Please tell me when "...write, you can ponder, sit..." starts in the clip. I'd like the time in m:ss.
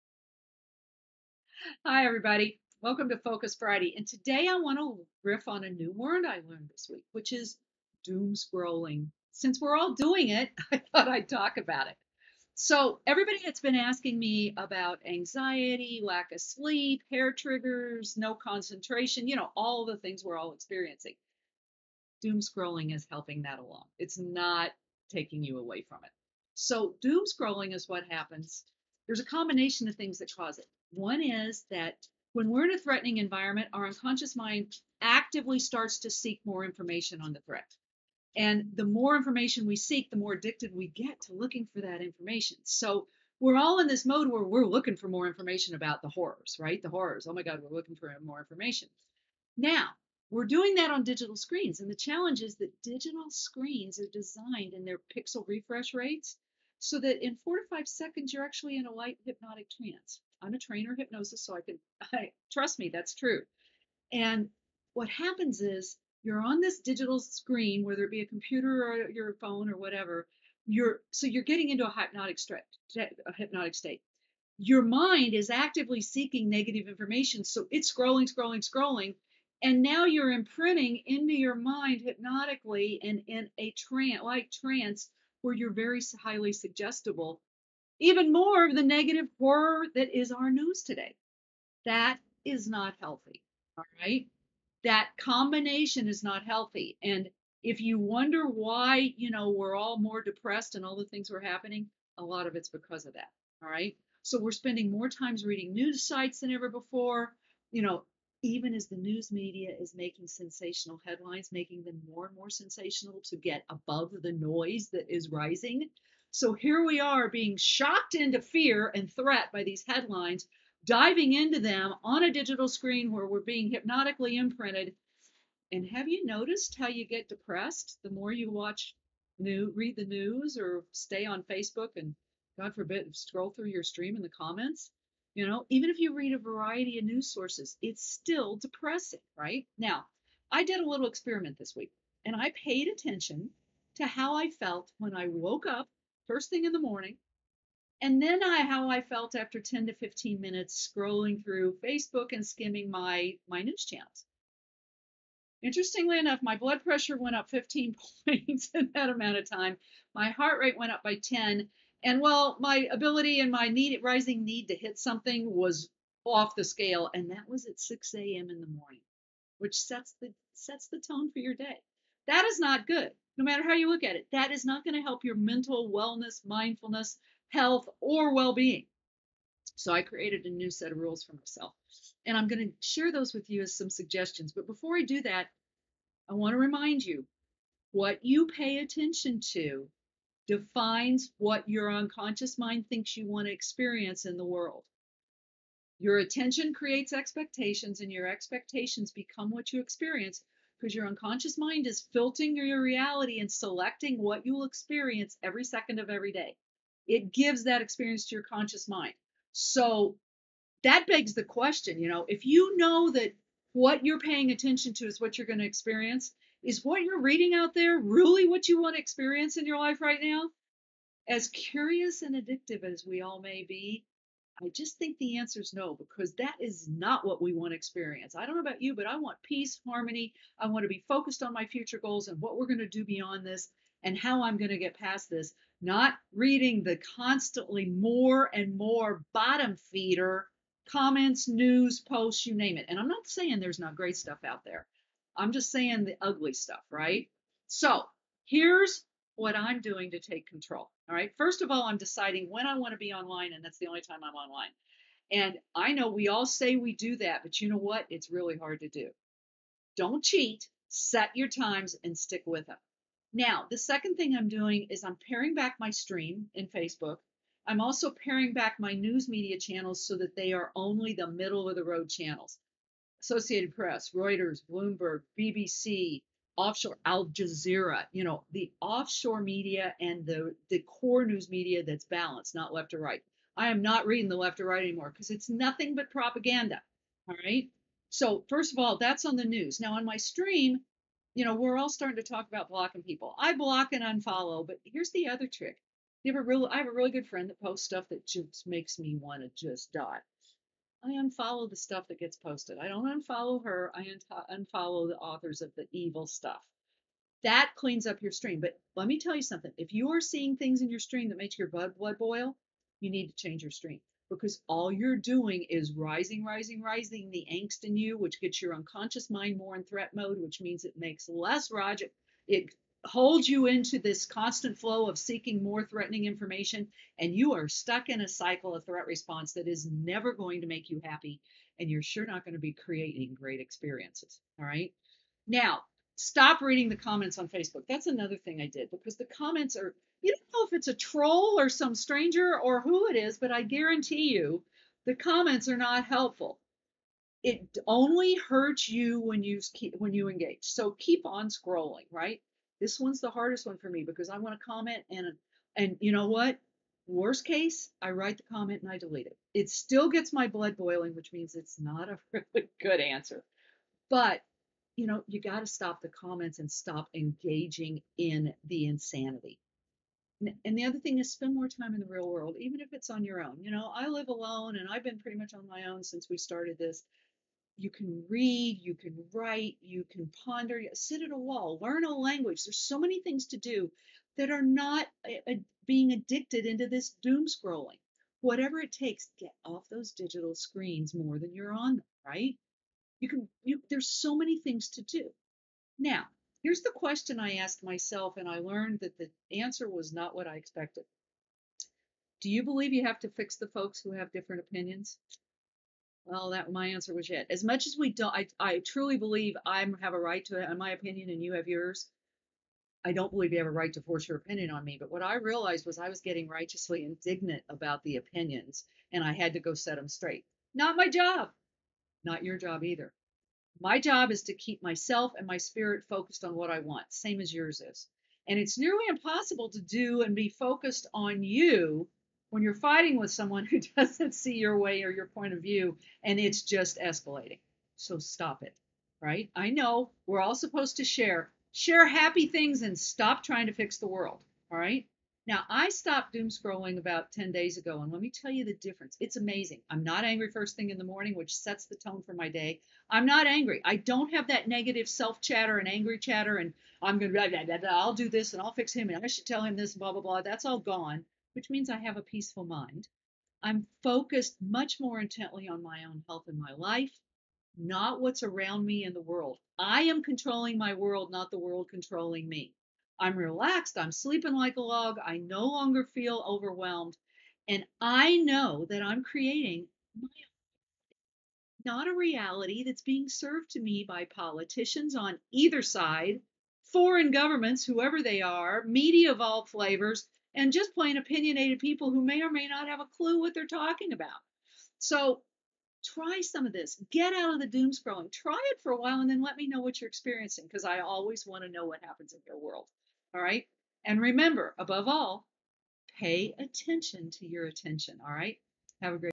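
6:19.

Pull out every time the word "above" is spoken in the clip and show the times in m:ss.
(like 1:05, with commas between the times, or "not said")
1:53, 8:24.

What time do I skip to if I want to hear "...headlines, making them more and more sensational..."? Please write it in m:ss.
1:51.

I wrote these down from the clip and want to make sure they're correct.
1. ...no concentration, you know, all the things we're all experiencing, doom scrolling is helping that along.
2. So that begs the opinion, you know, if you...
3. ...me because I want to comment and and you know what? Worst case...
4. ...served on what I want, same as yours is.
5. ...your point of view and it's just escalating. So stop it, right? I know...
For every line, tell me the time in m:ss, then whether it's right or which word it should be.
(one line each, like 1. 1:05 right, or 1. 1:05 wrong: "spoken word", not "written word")
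1. 0:18 right
2. 3:29 wrong: "question", not "opinion"
3. 5:53 right
4. 7:06 wrong: "focused", not "served"
5. 7:15 right.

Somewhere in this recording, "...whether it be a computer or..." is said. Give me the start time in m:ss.
1:07.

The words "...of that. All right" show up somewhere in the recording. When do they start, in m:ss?
1:43.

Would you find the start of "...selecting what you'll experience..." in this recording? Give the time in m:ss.
3:23.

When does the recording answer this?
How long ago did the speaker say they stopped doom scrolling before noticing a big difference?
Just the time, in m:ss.
7:27.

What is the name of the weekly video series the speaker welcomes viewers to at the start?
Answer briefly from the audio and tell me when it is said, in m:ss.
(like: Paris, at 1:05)
Focus Friday, at 0:03.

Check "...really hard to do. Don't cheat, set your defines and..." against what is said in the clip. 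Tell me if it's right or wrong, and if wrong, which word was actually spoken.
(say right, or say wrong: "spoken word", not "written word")
wrong: "times", not "defines".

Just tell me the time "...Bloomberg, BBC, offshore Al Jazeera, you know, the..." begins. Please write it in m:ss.
4:34.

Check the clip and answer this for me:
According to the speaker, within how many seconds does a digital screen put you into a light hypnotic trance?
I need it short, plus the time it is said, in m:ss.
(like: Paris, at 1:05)
4 to 5 seconds, at 0:57.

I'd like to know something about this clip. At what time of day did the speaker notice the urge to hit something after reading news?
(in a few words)
6 a.m.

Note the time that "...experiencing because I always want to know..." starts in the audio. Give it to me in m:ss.
8:20.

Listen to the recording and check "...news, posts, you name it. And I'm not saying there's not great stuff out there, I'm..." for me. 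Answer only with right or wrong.
right.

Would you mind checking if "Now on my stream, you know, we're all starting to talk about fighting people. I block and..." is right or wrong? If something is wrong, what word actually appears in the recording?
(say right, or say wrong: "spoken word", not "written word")
wrong: "blocking", not "fighting".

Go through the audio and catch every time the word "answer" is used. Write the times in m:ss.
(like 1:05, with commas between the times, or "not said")
3:45, 6:02, 6:39, 6:46.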